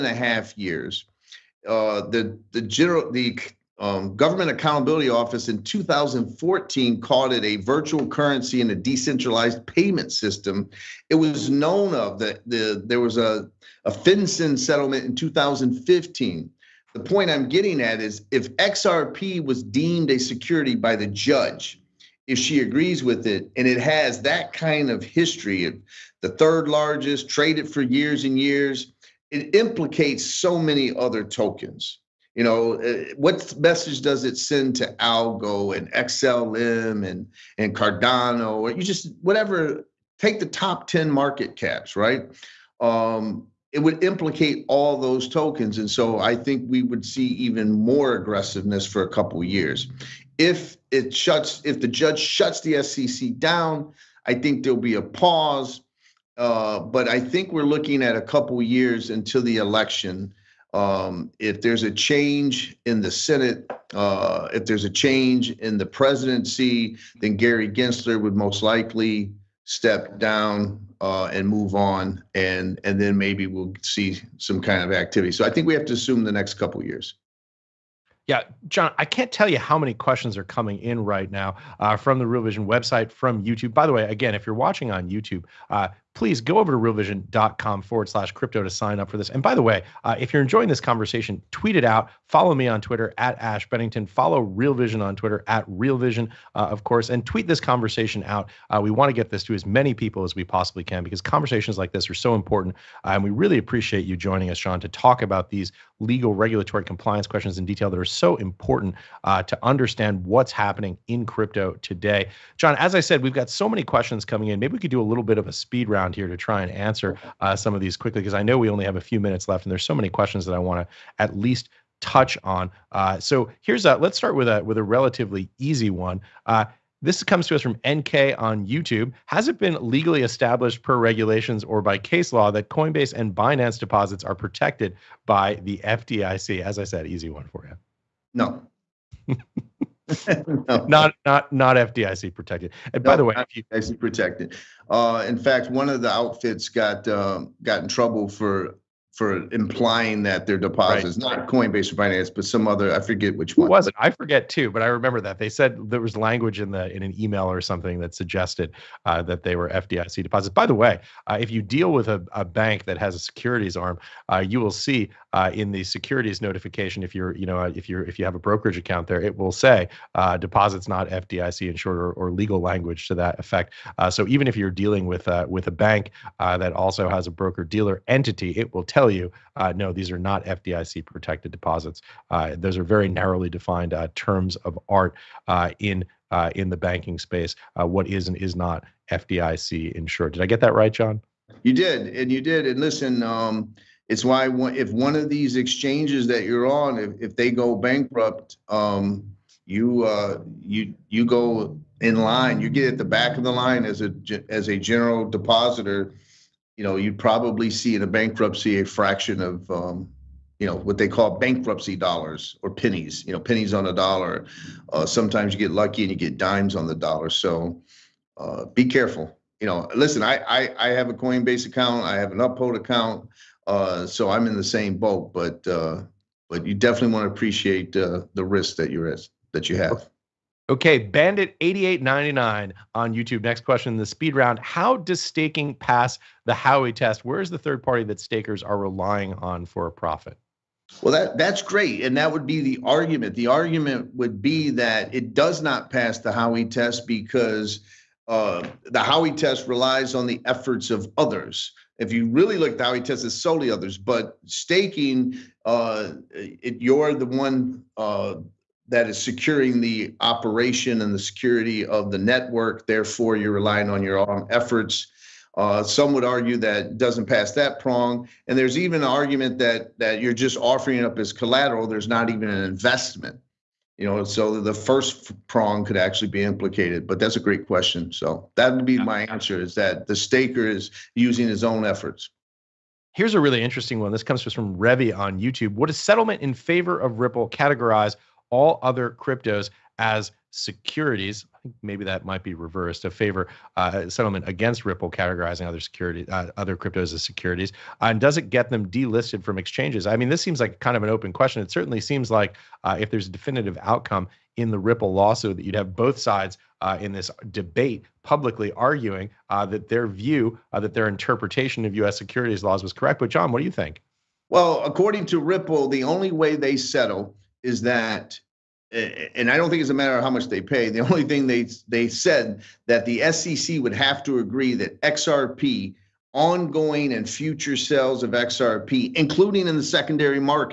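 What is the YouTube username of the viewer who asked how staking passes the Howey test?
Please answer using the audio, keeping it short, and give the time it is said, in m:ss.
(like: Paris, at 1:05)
Bandit 8899, at 3:50.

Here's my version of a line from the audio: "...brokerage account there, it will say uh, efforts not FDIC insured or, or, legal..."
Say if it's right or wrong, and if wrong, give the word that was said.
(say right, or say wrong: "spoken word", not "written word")
wrong: "deposits", not "efforts".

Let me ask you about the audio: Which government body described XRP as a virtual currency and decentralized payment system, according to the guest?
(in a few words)
Government Accountability Office.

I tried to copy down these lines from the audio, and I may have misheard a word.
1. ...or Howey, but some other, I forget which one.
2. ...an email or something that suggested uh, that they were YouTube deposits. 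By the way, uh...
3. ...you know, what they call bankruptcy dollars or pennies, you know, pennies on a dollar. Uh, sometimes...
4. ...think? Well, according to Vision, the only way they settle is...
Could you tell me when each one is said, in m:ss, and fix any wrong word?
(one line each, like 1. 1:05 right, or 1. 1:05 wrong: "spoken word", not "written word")
1. 2:31 wrong: "Binance", not "Howey"
2. 2:37 wrong: "FDIC", not "YouTube"
3. 3:30 right
4. 5:13 wrong: "Ripple", not "Vision".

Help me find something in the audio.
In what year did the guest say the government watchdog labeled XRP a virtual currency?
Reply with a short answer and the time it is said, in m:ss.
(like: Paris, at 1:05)
2014, at 0:05.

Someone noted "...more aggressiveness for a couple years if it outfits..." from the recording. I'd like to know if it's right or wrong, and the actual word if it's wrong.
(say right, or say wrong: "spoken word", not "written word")
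wrong: "shuts", not "outfits".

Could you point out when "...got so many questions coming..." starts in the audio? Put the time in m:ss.
1:53.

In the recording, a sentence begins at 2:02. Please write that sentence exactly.
Uh, so here's a let's start with a with a relatively easy one.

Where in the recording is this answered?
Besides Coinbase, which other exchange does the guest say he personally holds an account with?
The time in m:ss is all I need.
3:42.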